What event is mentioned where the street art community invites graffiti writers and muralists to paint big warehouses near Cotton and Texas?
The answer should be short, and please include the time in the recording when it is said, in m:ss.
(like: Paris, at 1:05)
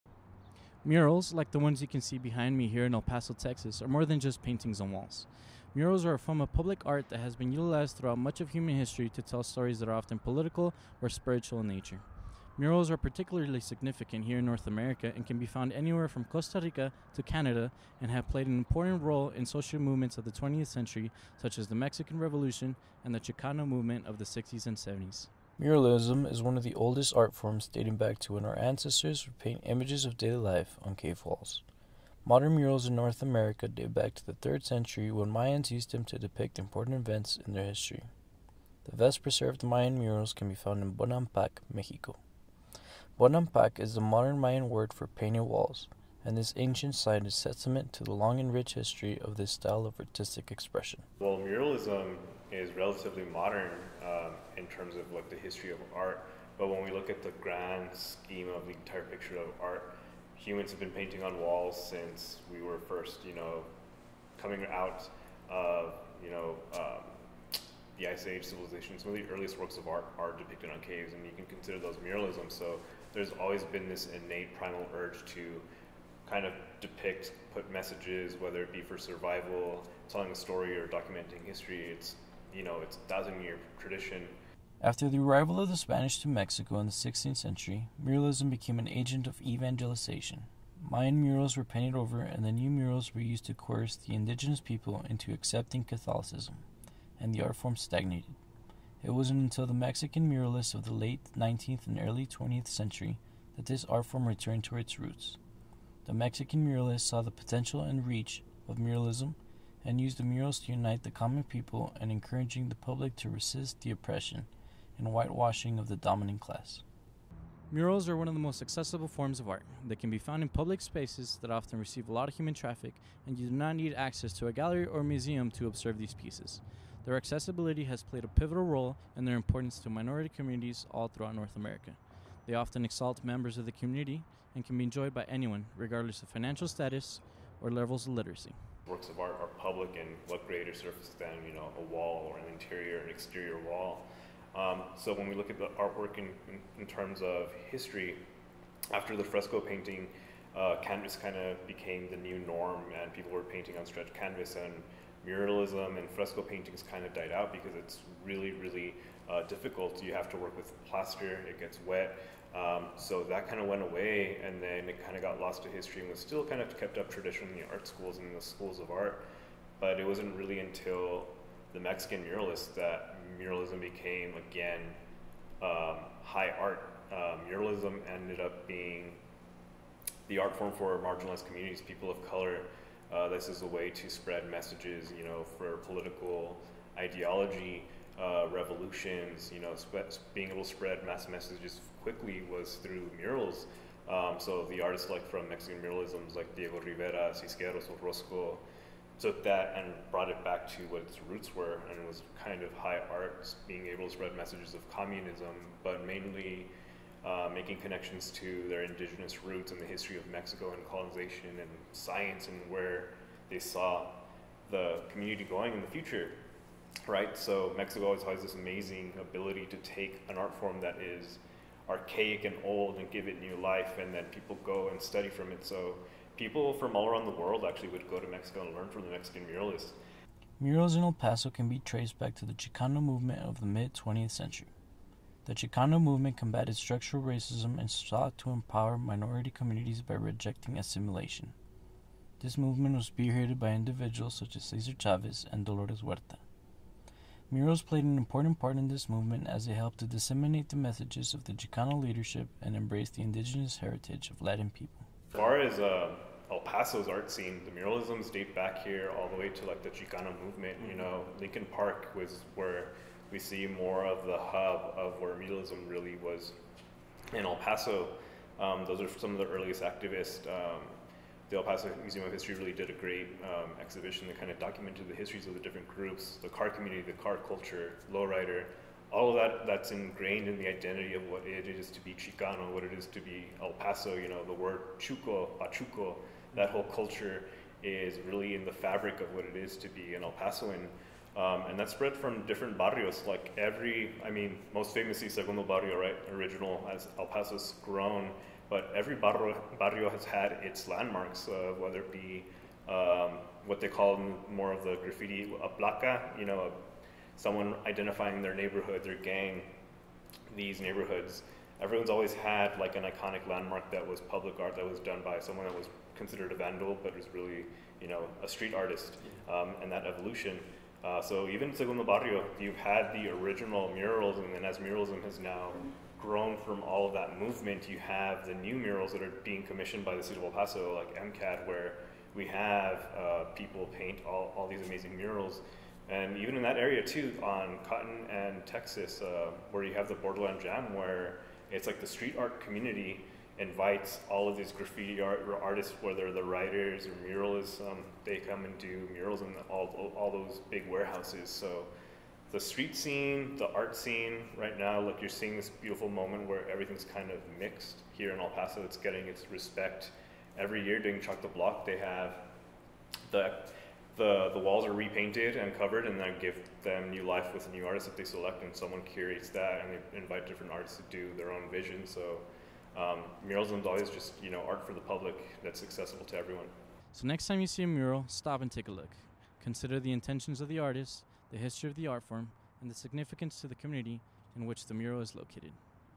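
Borderland Jam, at 5:40.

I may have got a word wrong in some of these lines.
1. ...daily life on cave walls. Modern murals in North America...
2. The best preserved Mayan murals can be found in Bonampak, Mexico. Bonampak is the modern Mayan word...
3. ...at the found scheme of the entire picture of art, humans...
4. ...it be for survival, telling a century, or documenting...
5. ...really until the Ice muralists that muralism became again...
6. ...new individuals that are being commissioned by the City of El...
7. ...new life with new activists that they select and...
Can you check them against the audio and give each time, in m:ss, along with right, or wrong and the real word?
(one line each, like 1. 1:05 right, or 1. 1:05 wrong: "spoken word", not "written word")
1. 0:30 right
2. 0:38 right
3. 0:57 wrong: "grand", not "found"
4. 1:18 wrong: "story", not "century"
5. 2:50 wrong: "Mexican", not "Ice"
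6. 5:28 wrong: "murals", not "individuals"
7. 6:07 wrong: "artists", not "activists".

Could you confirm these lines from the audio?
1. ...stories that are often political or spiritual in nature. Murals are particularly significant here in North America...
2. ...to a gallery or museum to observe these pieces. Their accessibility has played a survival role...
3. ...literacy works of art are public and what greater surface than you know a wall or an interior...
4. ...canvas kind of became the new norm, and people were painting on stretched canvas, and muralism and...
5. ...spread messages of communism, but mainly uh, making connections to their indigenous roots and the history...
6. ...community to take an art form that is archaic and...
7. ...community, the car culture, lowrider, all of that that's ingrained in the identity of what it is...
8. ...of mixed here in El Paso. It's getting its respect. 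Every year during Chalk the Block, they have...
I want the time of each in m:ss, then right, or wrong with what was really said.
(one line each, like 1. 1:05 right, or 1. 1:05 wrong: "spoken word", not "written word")
1. 0:09 right
2. 2:04 wrong: "pivotal", not "survival"
3. 2:18 right
4. 2:30 right
5. 3:24 right
6. 3:39 wrong: "ability", not "community"
7. 4:36 right
8. 5:57 right.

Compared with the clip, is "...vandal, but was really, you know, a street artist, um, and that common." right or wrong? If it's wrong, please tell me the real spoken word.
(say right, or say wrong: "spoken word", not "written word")
wrong: "evolution", not "common".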